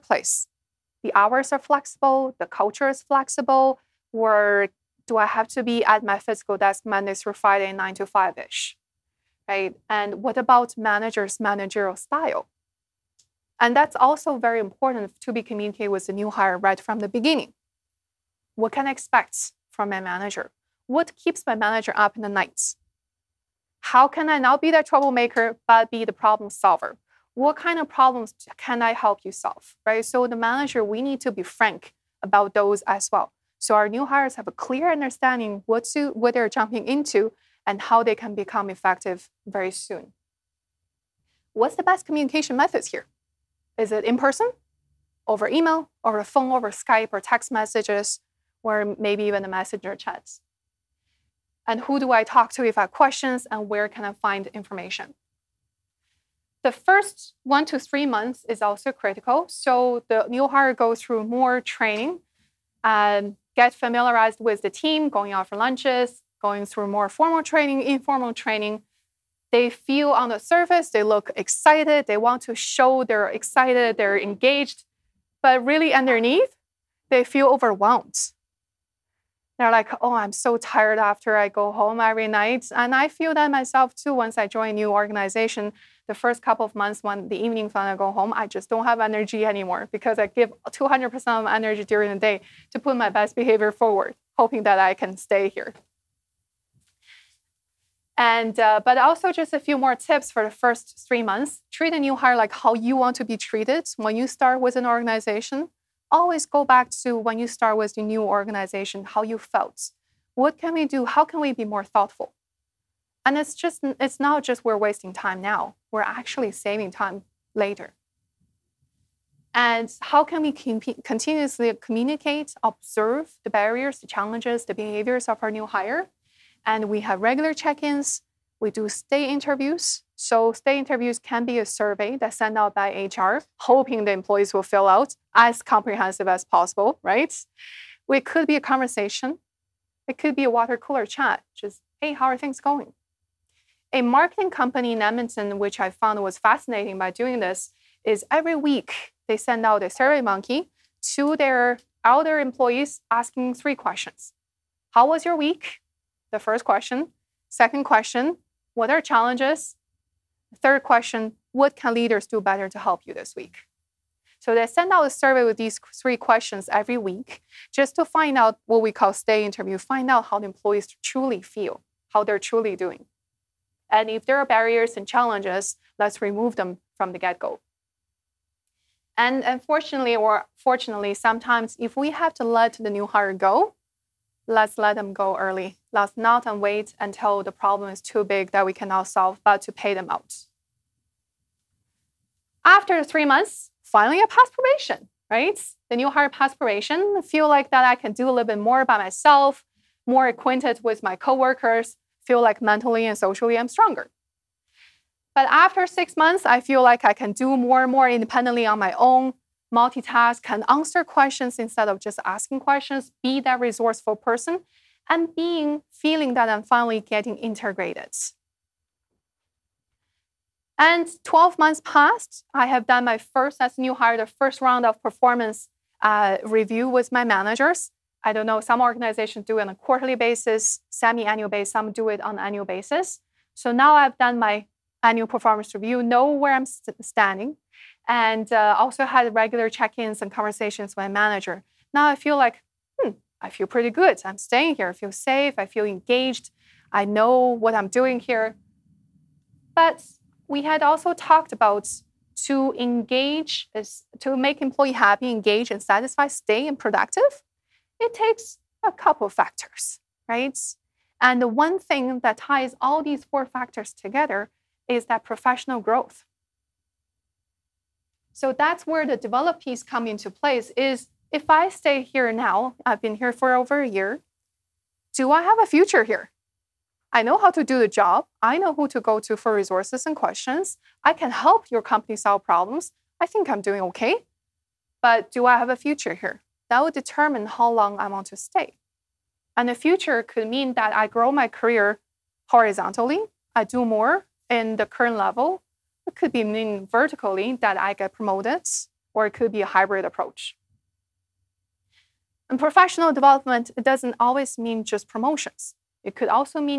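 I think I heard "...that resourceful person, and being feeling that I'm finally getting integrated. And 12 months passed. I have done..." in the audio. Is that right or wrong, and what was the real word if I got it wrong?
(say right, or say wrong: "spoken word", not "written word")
right.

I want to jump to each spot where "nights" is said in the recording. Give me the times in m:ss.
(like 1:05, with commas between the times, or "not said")
0:22, 1:22.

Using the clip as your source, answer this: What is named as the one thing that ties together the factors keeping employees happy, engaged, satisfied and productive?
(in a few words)
professional growth.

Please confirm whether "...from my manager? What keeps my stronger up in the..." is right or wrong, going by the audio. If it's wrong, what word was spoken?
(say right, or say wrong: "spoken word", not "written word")
wrong: "manager", not "stronger".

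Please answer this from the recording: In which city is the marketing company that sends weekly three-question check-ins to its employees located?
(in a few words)
Edmonton.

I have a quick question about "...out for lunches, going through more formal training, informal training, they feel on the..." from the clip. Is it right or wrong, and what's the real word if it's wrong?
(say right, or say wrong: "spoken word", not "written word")
right.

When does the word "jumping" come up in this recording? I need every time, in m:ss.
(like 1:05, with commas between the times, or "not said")
0:36.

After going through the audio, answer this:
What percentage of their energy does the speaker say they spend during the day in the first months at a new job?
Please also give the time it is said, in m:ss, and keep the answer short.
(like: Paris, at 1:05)
200%, at 1:30.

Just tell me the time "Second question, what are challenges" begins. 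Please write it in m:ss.
2:37.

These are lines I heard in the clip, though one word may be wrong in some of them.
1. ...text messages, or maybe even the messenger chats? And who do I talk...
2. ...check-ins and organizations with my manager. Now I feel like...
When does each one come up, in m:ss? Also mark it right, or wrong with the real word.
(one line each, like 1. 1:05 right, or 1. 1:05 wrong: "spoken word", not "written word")
1. 0:47 right
2. 3:59 wrong: "conversations", not "organizations".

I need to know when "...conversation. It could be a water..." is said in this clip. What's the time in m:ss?
2:18.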